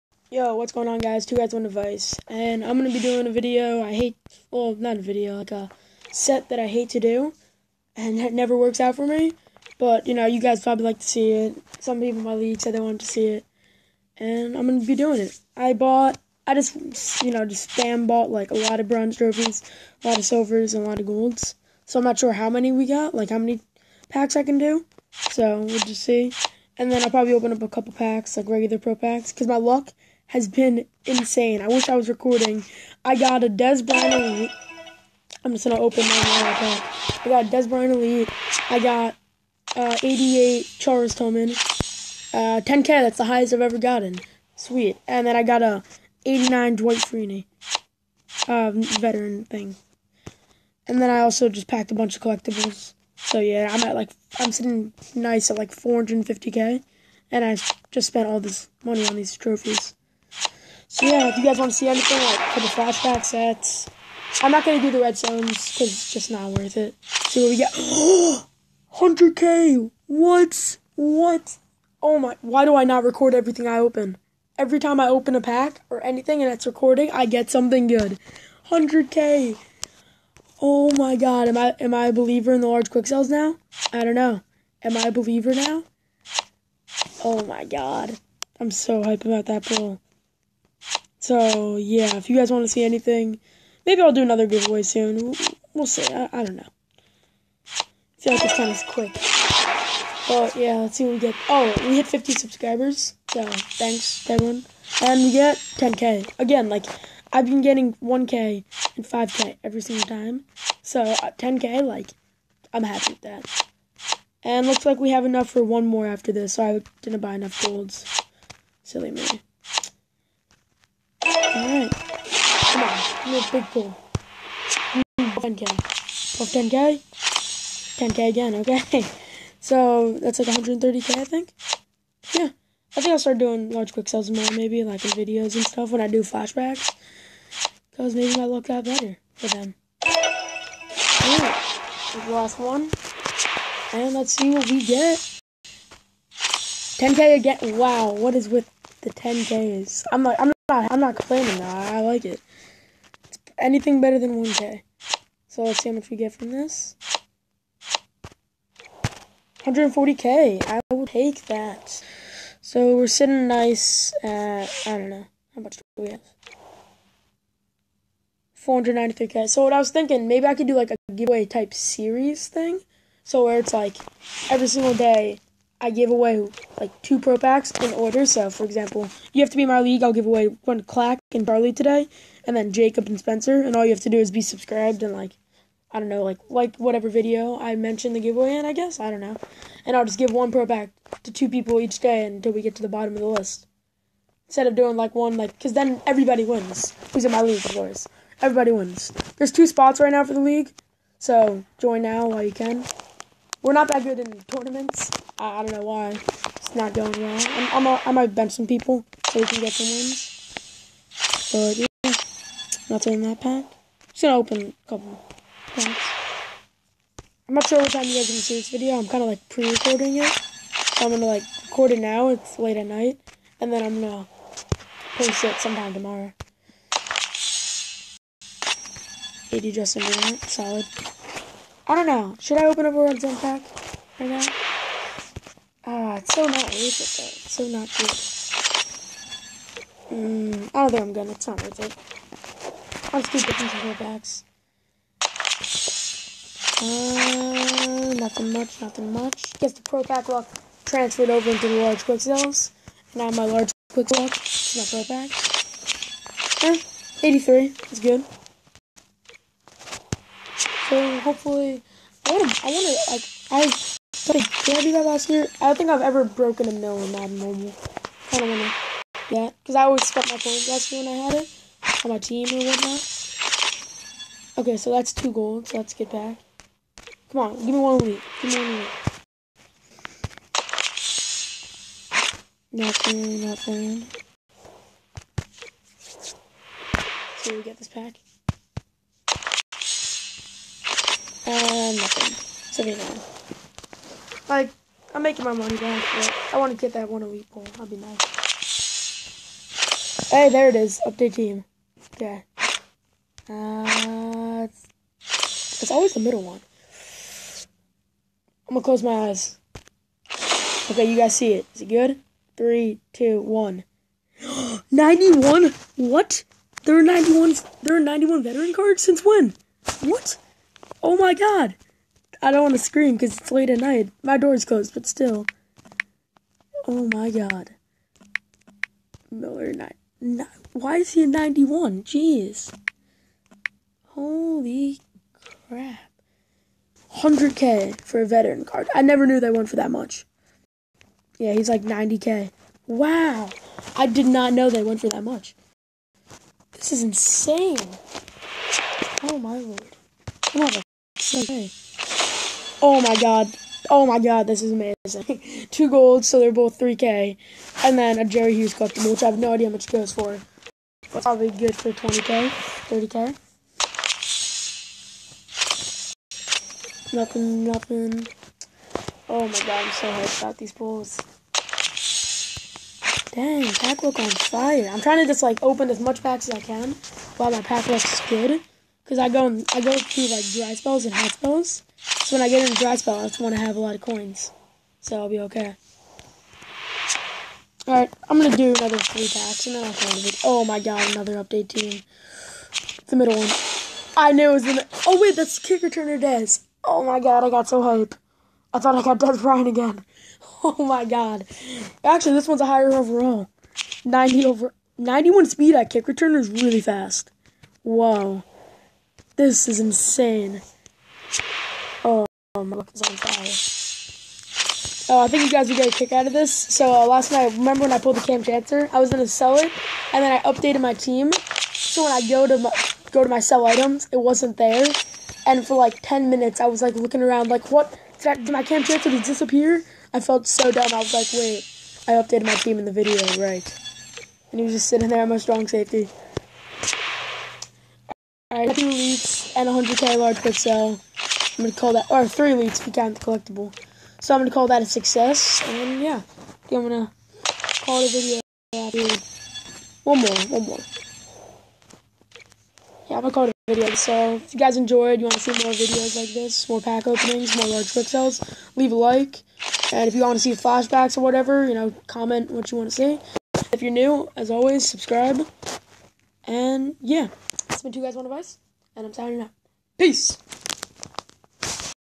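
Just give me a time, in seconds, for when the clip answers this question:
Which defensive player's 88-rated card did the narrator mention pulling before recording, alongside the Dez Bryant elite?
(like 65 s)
40 s.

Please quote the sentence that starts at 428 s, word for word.
Did, I, did my Kam Chancellor disappear?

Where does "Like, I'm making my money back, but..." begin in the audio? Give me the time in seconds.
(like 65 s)
294 s.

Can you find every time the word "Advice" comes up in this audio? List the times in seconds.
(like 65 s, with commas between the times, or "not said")
468 s.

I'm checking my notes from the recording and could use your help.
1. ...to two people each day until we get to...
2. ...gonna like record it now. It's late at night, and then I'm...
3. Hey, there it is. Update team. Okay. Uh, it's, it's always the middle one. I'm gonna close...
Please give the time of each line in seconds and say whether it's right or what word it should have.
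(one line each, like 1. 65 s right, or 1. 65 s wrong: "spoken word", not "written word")
1. 191 s right
2. 221 s right
3. 300 s right.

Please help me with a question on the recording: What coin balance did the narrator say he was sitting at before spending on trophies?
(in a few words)
450k.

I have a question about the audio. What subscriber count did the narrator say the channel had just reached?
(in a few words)
50.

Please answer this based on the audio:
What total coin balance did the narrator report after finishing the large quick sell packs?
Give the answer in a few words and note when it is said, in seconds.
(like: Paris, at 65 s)
493K, at 168 s.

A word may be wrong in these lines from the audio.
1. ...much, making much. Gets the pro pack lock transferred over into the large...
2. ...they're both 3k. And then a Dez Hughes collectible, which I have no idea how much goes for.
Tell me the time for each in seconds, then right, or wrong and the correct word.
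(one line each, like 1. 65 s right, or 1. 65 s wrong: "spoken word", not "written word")
1. 248 s wrong: "nothing", not "making"
2. 356 s wrong: "Jerry", not "Dez".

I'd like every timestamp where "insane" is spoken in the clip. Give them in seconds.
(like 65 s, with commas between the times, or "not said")
31 s, 347 s, 409 s.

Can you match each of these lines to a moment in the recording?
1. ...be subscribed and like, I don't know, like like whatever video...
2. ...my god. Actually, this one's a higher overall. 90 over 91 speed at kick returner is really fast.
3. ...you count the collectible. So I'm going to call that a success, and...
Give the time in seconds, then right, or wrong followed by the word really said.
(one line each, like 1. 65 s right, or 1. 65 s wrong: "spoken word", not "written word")
1. 184 s right
2. 400 s right
3. 442 s right.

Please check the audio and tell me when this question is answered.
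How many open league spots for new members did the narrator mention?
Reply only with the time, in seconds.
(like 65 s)
199 s.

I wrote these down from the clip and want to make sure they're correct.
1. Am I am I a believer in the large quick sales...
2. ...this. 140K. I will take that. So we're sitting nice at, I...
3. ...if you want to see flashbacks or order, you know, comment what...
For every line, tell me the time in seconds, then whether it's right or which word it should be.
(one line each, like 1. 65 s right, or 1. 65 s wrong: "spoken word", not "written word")
1. 81 s right
2. 156 s right
3. 460 s wrong: "whatever", not "order".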